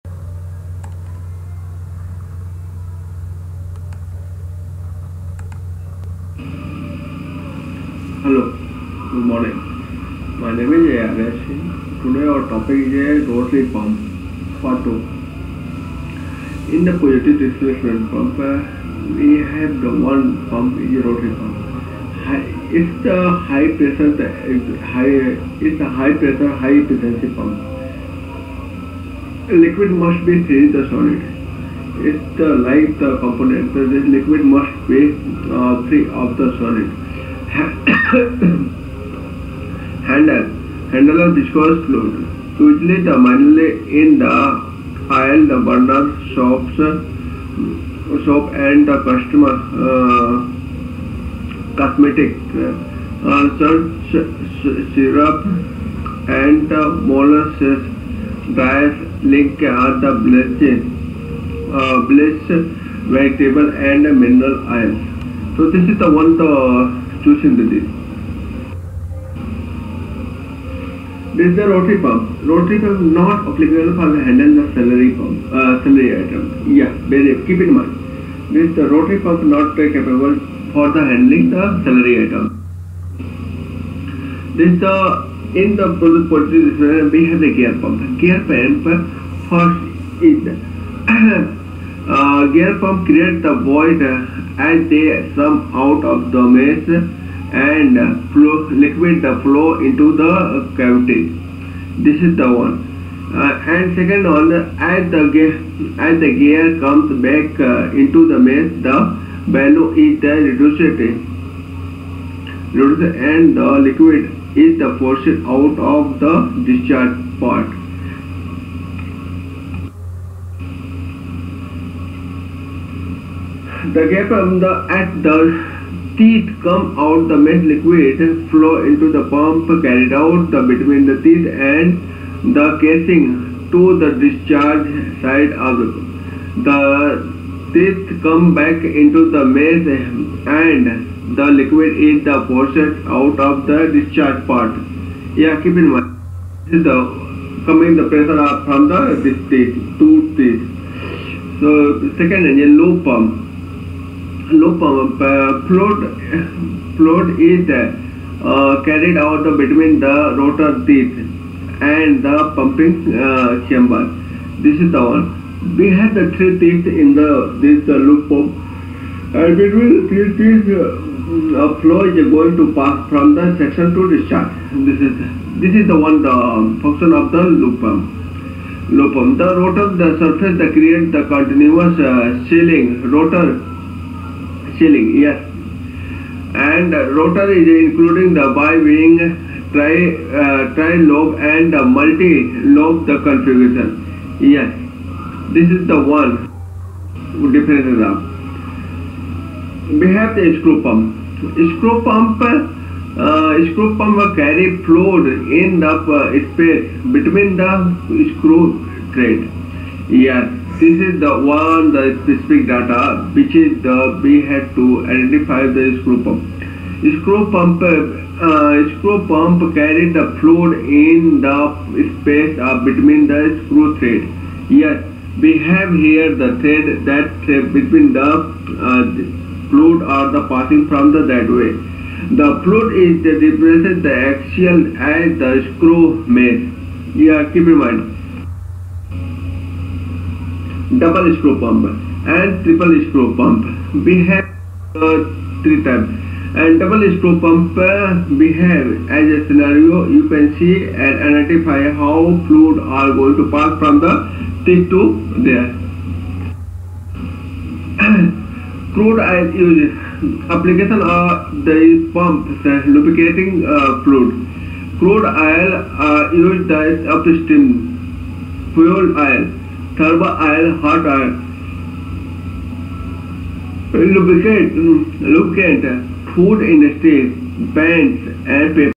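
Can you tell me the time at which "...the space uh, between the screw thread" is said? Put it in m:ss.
3:41.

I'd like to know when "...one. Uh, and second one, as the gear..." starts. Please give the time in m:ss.
1:42.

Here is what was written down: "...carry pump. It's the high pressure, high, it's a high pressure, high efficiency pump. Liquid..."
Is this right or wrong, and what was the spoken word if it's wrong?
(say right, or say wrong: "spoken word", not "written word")
wrong: "rotary", not "carry".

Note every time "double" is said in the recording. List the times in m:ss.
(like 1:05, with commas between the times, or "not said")
4:00, 4:06.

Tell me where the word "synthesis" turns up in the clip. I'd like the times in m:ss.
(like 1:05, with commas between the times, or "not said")
1:07.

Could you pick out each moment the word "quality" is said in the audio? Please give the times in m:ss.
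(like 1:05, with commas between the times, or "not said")
not said.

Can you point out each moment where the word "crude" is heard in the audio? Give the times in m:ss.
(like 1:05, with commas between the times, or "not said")
4:18, 4:24.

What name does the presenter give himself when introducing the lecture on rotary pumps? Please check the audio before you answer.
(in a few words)
Yaresh.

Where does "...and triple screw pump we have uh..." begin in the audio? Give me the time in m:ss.
4:02.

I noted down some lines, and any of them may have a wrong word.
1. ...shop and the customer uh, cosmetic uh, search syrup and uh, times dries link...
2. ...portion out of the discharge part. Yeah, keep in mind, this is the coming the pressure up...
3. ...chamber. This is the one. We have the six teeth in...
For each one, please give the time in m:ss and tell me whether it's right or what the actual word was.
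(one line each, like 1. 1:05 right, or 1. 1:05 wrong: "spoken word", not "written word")
1. 0:48 wrong: "molasses", not "times"
2. 2:22 right
3. 2:43 wrong: "three", not "six".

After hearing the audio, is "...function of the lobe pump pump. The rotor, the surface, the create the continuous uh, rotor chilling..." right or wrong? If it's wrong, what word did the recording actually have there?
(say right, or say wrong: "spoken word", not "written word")
right.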